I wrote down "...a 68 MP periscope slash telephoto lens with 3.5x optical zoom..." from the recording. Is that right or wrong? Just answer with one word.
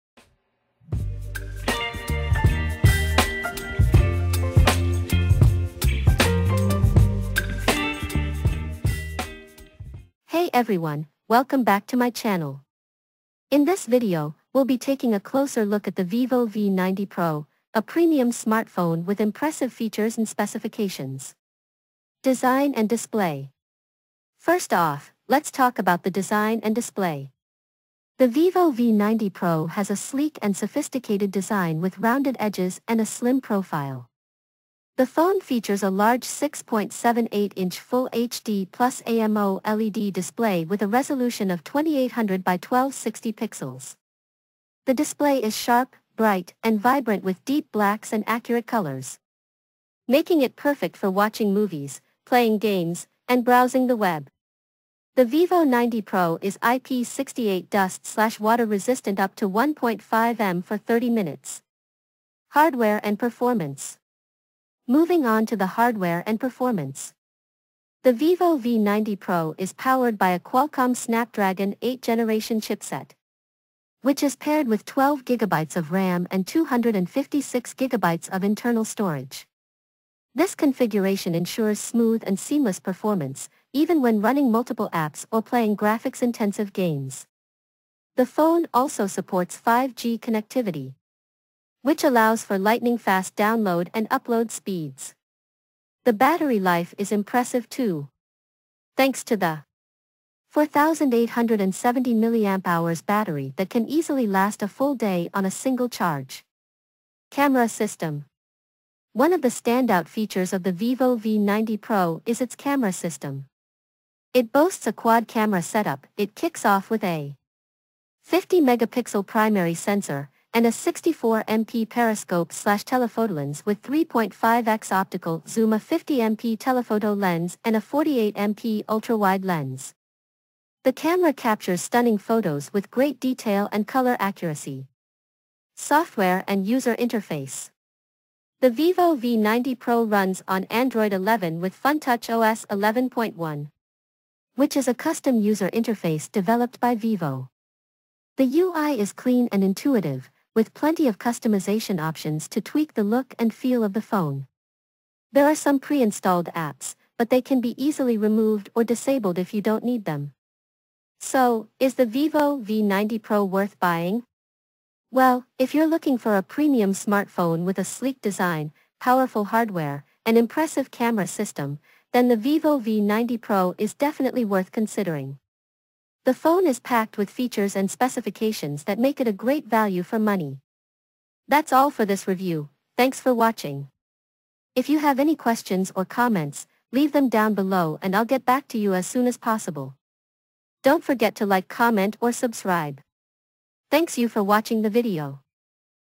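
wrong.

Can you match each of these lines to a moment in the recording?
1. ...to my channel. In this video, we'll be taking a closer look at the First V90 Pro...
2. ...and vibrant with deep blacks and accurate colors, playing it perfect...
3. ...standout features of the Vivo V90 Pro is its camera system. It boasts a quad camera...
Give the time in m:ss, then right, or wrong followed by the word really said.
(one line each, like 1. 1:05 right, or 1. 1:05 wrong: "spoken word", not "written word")
1. 0:11 wrong: "Vivo", not "First"
2. 0:46 wrong: "making", not "playing"
3. 1:49 right.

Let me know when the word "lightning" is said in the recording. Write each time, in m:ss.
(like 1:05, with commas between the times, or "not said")
1:32.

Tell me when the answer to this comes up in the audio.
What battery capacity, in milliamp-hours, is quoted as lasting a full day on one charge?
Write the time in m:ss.
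1:40.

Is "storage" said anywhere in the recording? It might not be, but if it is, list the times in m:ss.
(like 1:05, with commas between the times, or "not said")
1:18.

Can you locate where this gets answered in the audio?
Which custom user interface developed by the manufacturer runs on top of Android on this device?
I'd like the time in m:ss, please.
2:21.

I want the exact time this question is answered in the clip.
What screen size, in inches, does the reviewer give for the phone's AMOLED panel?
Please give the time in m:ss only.
0:36.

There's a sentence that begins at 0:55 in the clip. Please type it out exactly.
The Vivo 90 Pro is IP68 dust-water resistant up to 1.5 m for 30 minutes.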